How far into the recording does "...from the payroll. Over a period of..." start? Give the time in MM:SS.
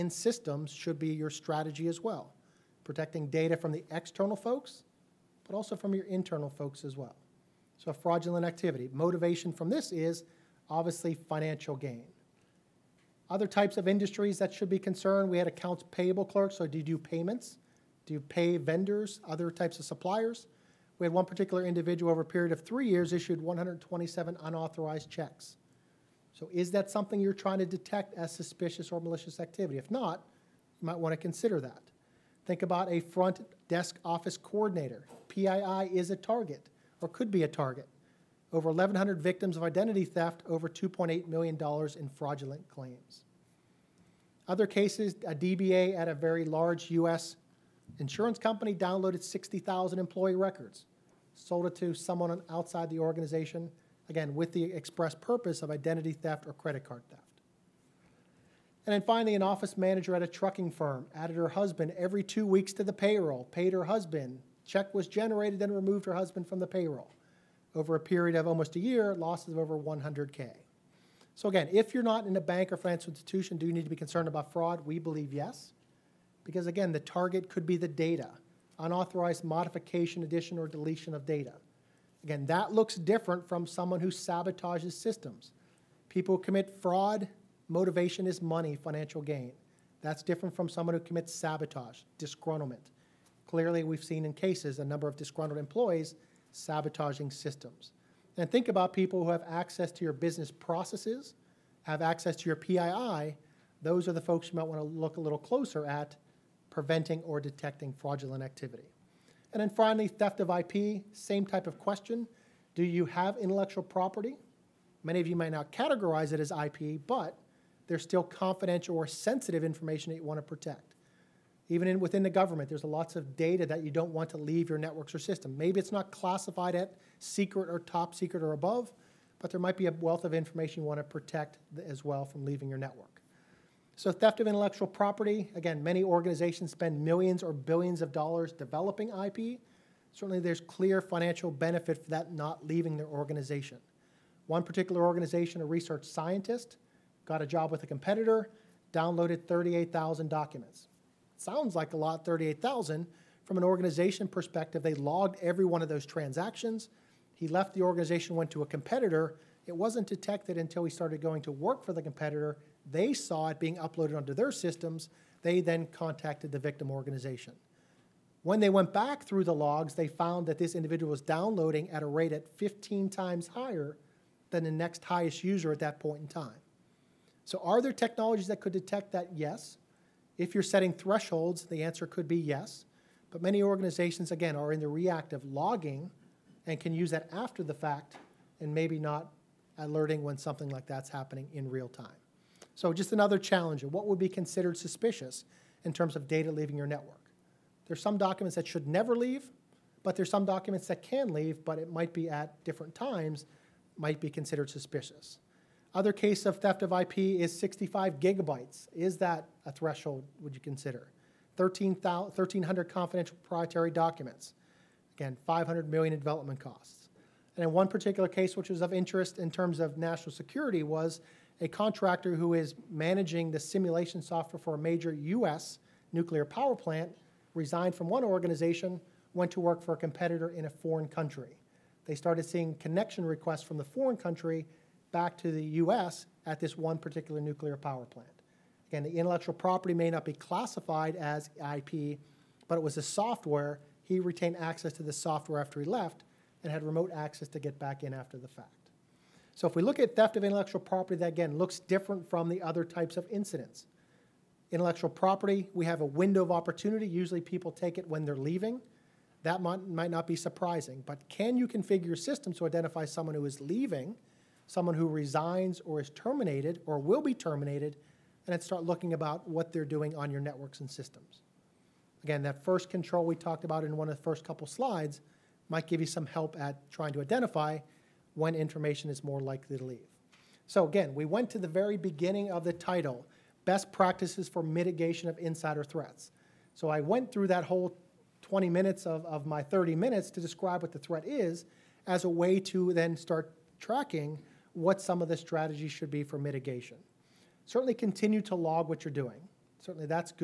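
01:06.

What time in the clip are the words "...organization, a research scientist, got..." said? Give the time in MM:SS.
02:25.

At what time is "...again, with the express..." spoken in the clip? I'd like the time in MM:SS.
00:54.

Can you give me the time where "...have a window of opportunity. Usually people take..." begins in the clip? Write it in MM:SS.
04:15.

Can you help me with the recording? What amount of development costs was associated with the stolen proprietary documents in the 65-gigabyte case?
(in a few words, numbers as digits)
500 million.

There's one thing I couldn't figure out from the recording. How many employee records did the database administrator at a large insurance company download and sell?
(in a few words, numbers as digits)
60,000.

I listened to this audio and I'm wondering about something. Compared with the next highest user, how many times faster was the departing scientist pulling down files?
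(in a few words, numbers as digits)
15 times.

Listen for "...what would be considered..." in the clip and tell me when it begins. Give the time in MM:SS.
03:13.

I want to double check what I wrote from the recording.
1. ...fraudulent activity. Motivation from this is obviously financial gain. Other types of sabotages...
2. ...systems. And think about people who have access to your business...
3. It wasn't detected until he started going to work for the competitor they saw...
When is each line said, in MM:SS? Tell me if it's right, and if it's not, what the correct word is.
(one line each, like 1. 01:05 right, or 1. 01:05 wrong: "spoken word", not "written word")
1. 00:07 wrong: "industries", not "sabotages"
2. 01:37 right
3. 02:39 right.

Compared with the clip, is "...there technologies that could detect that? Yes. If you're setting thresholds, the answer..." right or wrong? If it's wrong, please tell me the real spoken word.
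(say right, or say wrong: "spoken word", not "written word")
right.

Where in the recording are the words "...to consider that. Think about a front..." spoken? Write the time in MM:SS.
00:31.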